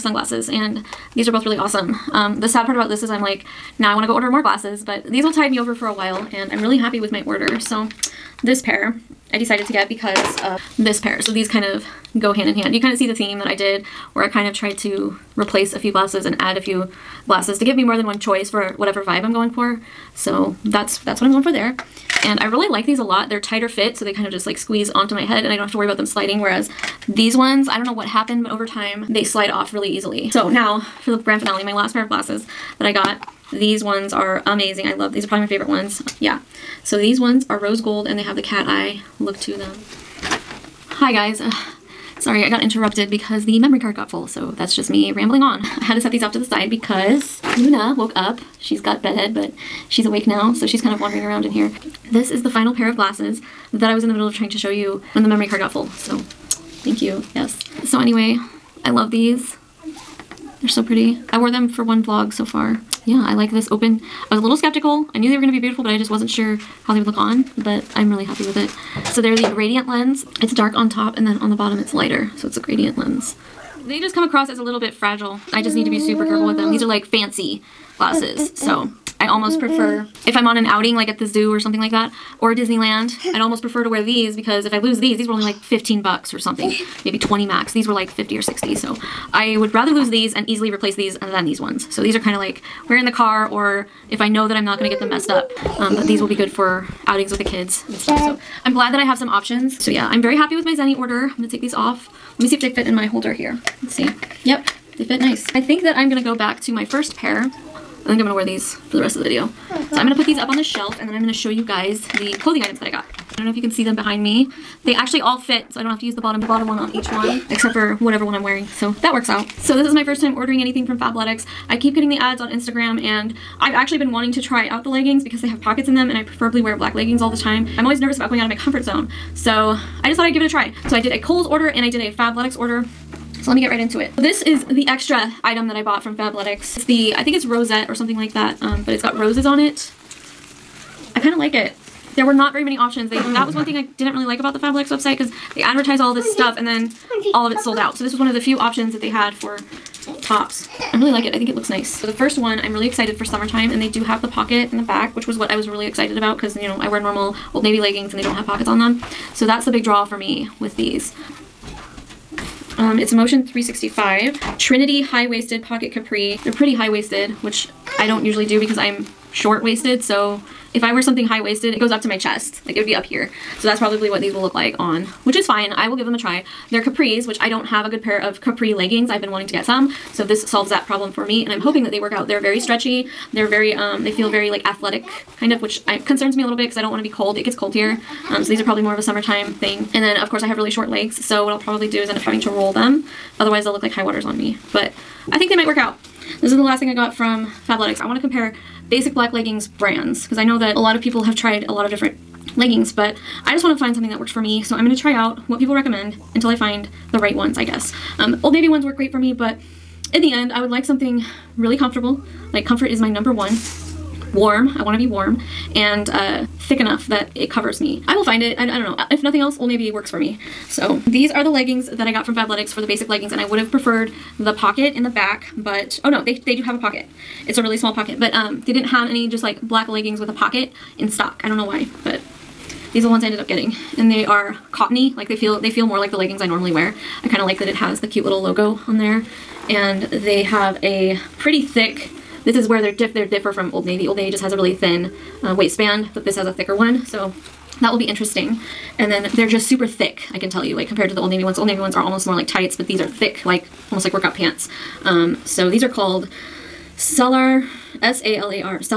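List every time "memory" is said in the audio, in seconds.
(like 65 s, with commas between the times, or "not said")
43 s, 55 s.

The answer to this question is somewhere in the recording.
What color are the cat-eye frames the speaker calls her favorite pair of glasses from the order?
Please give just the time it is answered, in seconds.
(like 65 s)
37 s.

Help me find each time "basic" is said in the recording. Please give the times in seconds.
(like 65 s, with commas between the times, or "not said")
198 s, 222 s.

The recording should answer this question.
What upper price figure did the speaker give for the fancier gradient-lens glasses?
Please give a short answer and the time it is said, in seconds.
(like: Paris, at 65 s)
60, at 88 s.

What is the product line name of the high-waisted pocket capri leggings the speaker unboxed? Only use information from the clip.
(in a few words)
Motion 365.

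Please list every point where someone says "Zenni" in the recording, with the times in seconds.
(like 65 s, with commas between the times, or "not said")
100 s.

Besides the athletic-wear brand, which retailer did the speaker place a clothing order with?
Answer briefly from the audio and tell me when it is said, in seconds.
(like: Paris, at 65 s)
Kohl's, at 131 s.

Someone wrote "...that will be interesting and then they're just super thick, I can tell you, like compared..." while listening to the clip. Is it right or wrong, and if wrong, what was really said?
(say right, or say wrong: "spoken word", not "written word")
right.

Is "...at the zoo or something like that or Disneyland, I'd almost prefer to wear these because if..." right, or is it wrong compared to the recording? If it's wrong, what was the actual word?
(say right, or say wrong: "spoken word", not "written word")
right.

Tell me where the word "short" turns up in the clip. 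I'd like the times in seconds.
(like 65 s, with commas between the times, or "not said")
169 s, 190 s.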